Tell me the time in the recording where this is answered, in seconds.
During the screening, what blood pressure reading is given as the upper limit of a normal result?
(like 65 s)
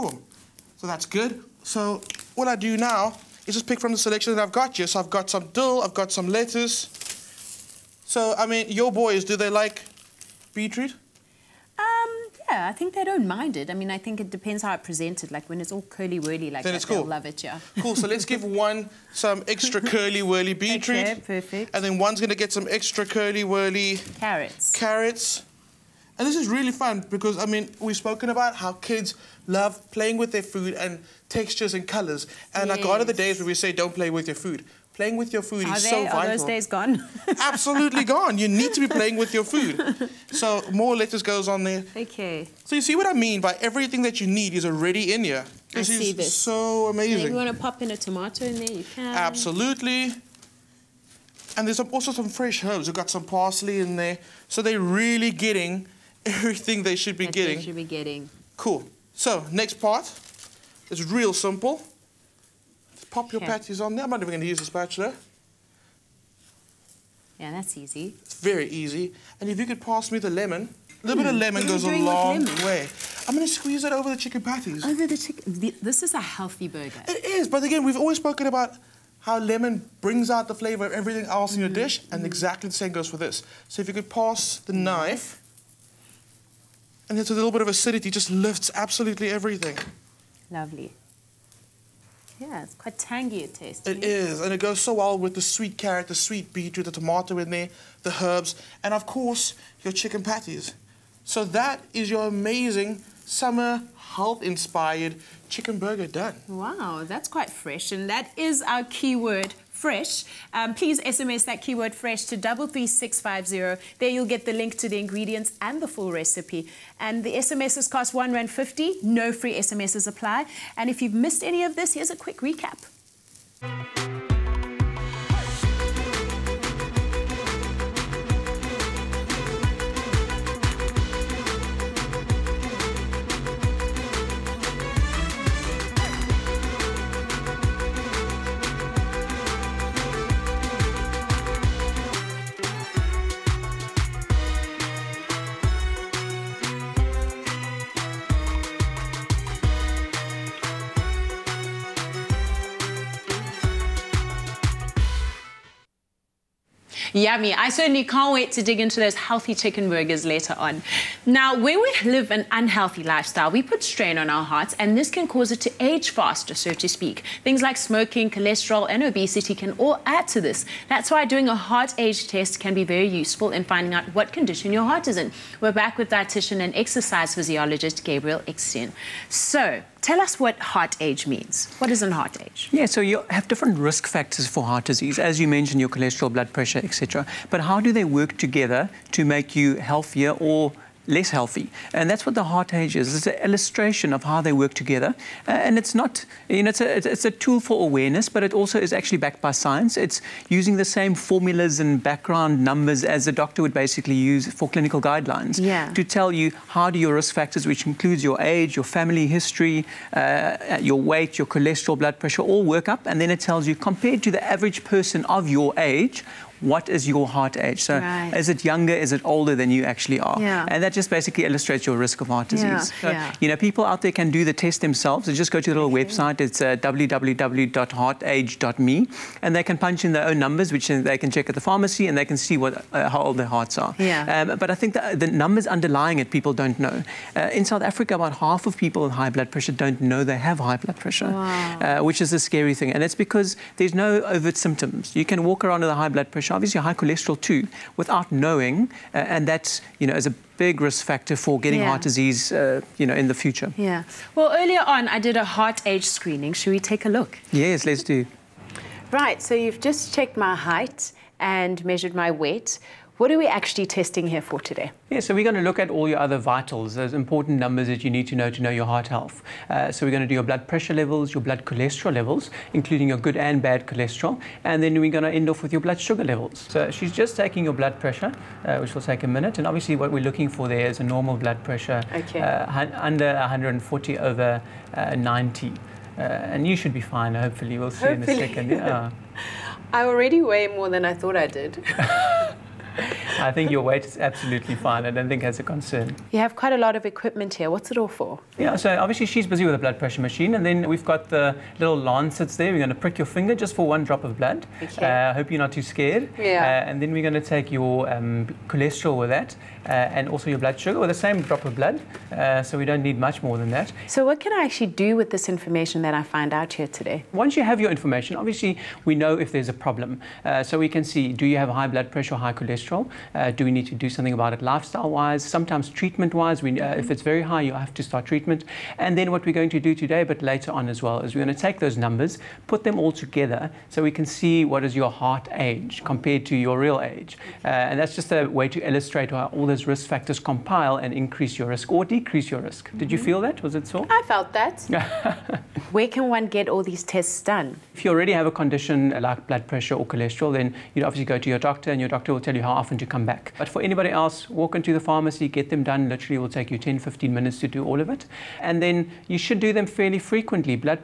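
283 s.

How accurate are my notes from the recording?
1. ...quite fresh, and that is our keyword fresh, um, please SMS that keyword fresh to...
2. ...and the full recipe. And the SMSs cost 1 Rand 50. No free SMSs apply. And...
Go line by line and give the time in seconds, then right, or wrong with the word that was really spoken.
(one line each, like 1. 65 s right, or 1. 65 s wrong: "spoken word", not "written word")
1. 107 s right
2. 115 s right.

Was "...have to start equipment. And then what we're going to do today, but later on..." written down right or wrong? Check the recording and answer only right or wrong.
wrong.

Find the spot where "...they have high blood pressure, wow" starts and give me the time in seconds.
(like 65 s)
240 s.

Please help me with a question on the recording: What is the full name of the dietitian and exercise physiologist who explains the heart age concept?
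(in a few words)
Gabriel Eksteen.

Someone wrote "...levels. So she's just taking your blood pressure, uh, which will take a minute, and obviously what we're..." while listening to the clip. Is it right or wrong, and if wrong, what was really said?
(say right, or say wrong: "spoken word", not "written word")
right.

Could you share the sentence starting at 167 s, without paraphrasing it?
Things like smoking, cholesterol and obesity can all add to this.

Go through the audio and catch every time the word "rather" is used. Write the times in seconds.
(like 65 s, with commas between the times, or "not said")
not said.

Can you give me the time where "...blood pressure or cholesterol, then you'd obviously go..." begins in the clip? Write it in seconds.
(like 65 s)
349 s.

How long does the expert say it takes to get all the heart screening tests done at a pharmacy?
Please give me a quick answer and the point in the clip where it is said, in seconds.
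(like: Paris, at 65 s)
10 to 15 minutes, at 356 s.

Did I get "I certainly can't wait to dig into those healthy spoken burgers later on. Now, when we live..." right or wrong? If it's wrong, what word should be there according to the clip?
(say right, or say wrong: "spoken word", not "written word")
wrong: "chicken", not "spoken".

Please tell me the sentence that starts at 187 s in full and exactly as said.
But how do they work together to make you healthier or less healthy.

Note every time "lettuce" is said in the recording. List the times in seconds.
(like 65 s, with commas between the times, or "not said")
6 s, 40 s.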